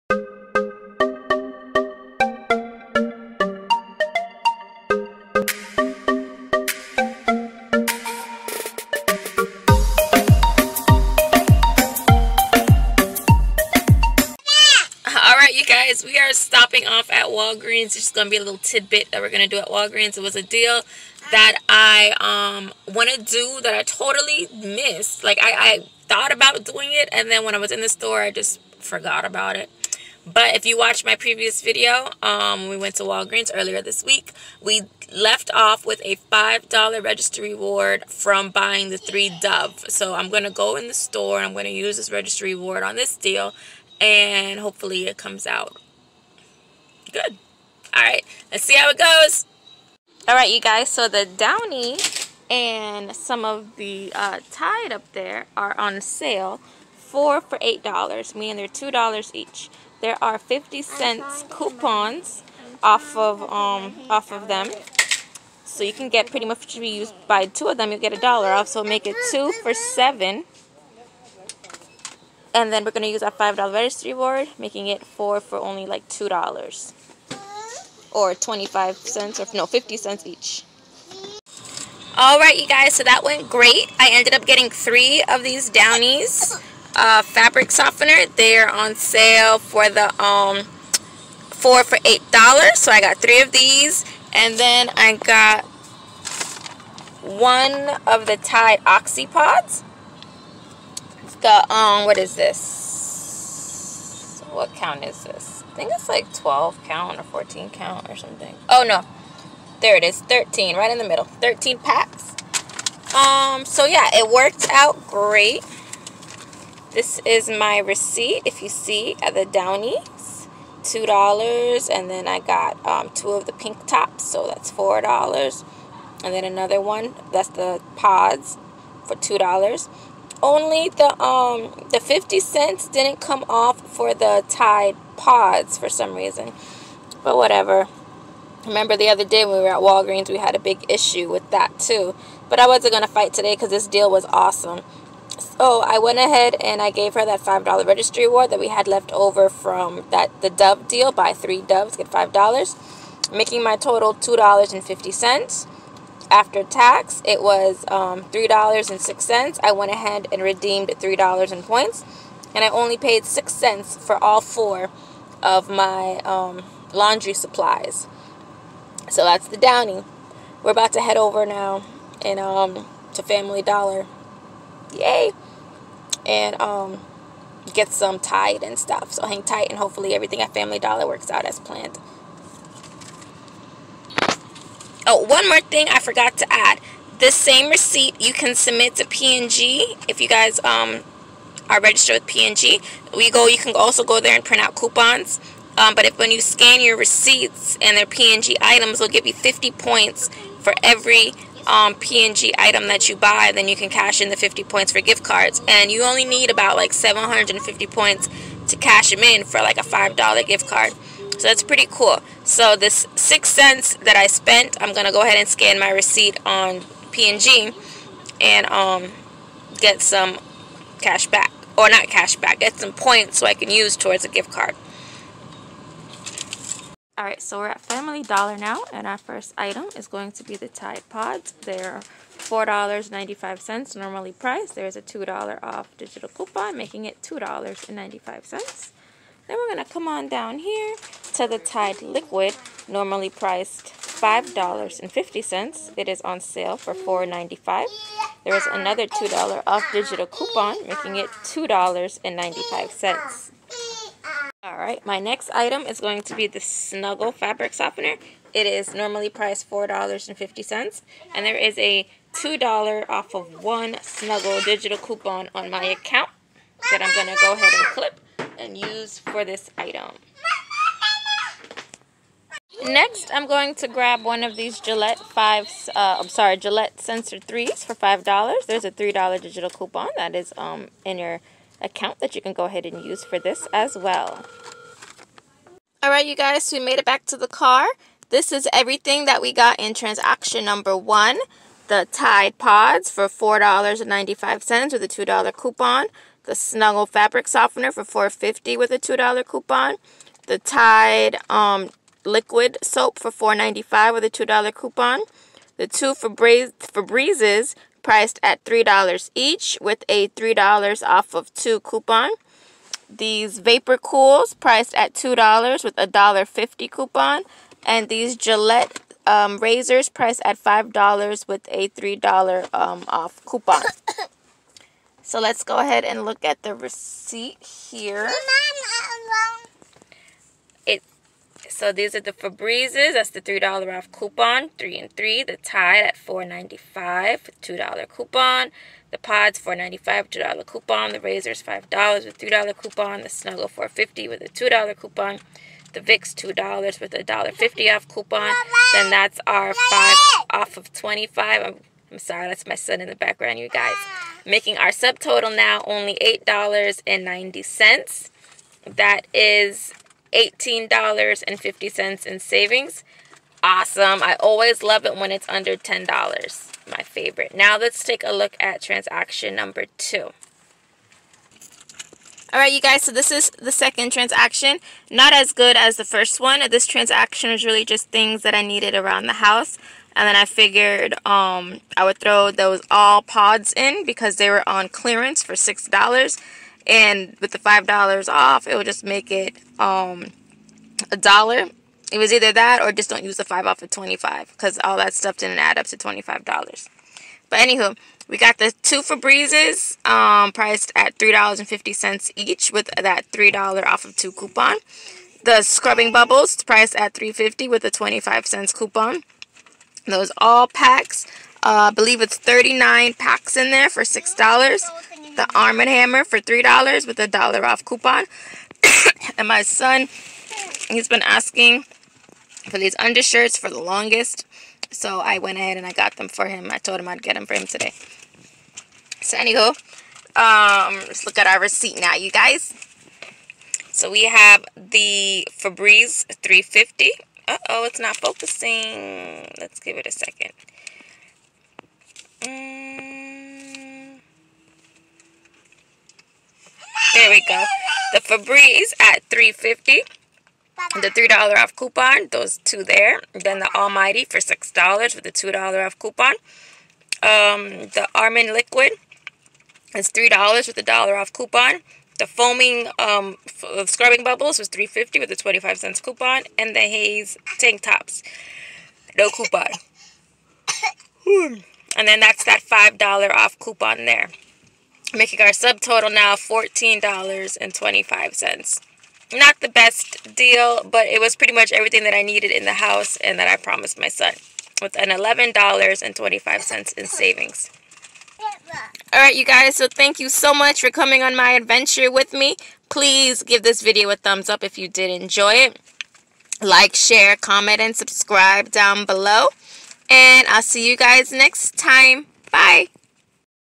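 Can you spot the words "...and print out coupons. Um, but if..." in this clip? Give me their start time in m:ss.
3:14.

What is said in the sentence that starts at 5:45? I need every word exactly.
The Vicks $2 with a $1.50 off coupon.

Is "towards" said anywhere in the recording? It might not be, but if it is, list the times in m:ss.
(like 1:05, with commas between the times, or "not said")
3:43.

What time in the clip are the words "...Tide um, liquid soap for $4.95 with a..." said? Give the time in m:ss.
5:00.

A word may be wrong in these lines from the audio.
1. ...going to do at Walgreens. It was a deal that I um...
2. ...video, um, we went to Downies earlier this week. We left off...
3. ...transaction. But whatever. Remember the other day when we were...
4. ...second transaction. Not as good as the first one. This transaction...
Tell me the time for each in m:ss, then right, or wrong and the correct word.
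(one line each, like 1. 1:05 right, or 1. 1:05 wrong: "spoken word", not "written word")
1. 0:19 right
2. 0:31 wrong: "Walgreens", not "Downies"
3. 2:16 wrong: "reason", not "transaction"
4. 6:13 right.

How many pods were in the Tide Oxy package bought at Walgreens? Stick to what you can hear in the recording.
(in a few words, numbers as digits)
13.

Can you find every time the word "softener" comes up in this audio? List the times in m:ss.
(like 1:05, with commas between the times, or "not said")
1:27, 4:17, 4:57.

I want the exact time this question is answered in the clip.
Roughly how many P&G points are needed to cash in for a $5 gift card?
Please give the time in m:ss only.
3:26.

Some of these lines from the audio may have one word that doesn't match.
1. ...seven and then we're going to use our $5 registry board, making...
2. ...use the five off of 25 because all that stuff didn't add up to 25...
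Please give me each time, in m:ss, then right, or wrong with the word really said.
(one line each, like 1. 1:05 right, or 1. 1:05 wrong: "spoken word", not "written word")
1. 1:09 right
2. 6:33 right.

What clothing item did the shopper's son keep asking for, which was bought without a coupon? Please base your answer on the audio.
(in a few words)
undershirts.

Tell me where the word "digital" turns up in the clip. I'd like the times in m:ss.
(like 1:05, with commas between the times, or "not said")
3:55, 4:09, 4:24, 4:39.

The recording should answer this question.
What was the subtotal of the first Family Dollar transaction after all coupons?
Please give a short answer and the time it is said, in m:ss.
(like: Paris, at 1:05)
$8.90, at 5:56.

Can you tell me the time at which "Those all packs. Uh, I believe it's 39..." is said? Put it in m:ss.
6:50.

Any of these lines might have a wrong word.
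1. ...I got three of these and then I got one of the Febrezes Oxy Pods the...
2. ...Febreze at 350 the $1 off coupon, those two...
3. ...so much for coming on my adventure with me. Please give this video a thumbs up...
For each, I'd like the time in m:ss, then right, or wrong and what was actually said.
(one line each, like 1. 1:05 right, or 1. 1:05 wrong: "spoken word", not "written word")
1. 1:32 wrong: "Tide", not "Febrezes"
2. 7:28 wrong: "3", not "1"
3. 8:10 right.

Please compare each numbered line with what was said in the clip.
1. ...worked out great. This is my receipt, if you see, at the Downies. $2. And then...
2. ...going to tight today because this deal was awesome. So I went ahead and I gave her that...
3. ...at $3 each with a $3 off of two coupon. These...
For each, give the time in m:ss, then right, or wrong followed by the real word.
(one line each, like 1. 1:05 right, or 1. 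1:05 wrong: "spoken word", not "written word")
1. 1:54 right
2. 2:22 wrong: "fight", not "tight"
3. 5:08 right.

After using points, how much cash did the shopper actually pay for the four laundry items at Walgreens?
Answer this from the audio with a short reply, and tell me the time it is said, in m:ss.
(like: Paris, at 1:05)
6 cents, at 2:43.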